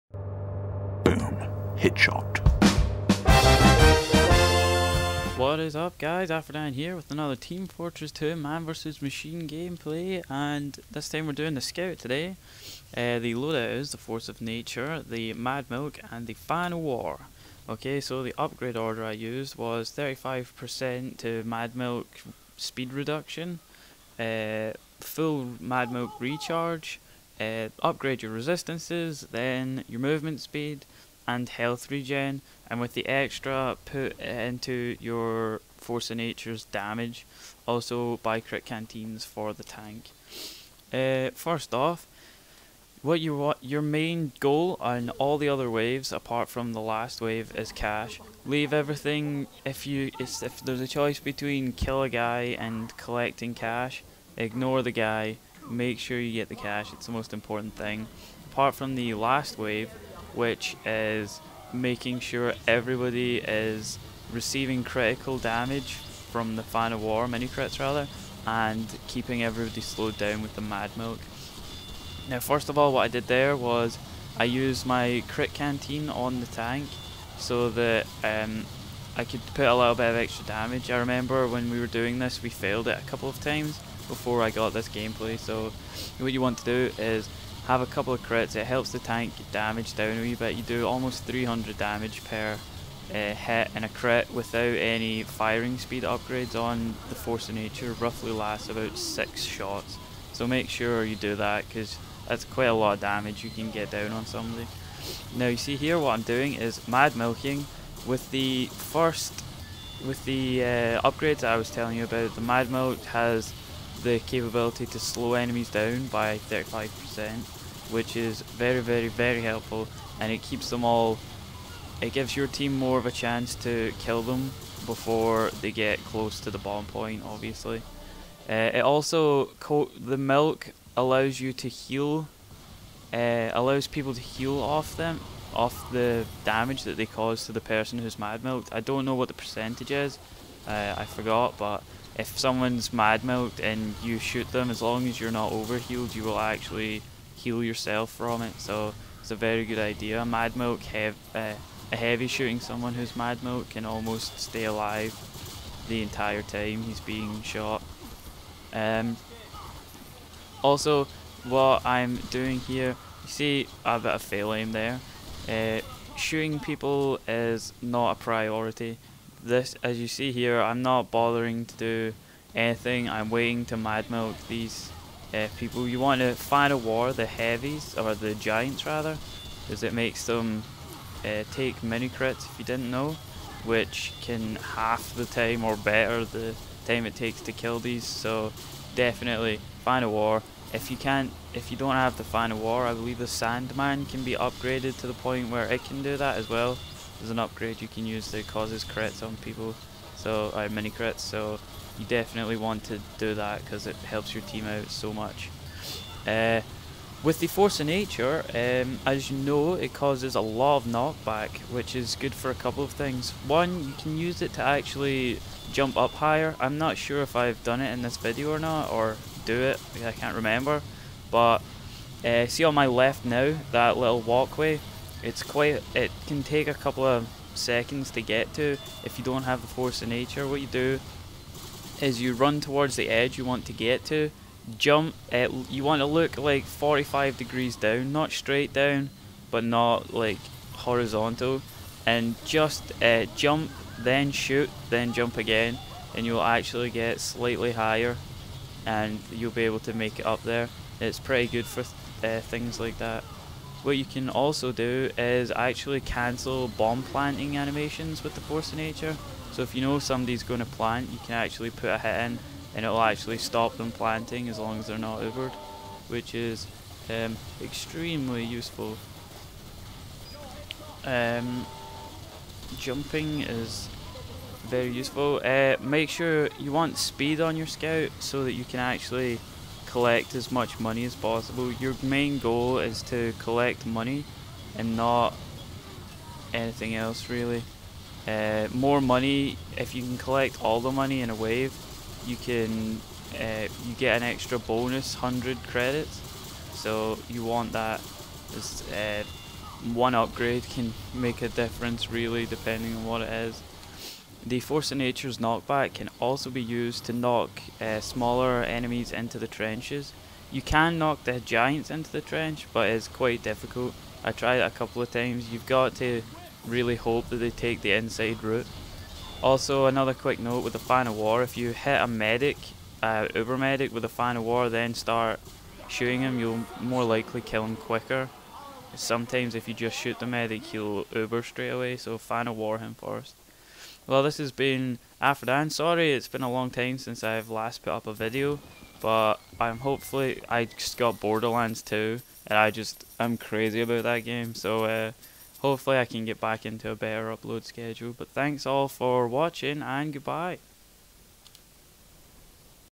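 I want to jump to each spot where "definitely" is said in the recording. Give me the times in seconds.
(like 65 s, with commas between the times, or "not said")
188 s, 202 s.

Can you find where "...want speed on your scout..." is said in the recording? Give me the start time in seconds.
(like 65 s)
276 s.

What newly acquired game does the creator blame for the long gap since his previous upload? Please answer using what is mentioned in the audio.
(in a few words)
Borderlands 2.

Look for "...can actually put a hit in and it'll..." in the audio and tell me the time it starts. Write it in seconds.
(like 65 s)
261 s.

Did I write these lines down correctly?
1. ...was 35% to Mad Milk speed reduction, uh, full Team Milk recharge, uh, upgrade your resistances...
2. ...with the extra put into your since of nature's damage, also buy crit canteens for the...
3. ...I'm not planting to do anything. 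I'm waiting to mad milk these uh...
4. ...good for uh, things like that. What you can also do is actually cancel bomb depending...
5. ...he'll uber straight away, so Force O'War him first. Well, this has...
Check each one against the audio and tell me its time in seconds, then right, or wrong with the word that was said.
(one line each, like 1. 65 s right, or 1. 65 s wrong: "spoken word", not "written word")
1. 19 s wrong: "Mad", not "Team"
2. 32 s wrong: "force", not "since"
3. 170 s wrong: "bothering", not "planting"
4. 251 s wrong: "planting", not "depending"
5. 330 s wrong: "Fan", not "Force".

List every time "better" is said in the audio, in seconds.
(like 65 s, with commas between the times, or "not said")
185 s, 346 s.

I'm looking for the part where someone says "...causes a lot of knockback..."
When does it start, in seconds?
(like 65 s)
209 s.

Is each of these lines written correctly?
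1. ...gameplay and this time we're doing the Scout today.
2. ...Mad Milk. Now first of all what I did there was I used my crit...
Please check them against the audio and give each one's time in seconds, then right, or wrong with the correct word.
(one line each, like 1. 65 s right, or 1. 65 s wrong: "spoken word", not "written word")
1. 9 s right
2. 70 s right.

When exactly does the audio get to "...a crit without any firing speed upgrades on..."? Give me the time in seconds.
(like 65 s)
93 s.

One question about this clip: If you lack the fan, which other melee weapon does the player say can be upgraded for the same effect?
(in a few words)
Sandman.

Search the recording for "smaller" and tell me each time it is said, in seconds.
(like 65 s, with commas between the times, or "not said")
307 s.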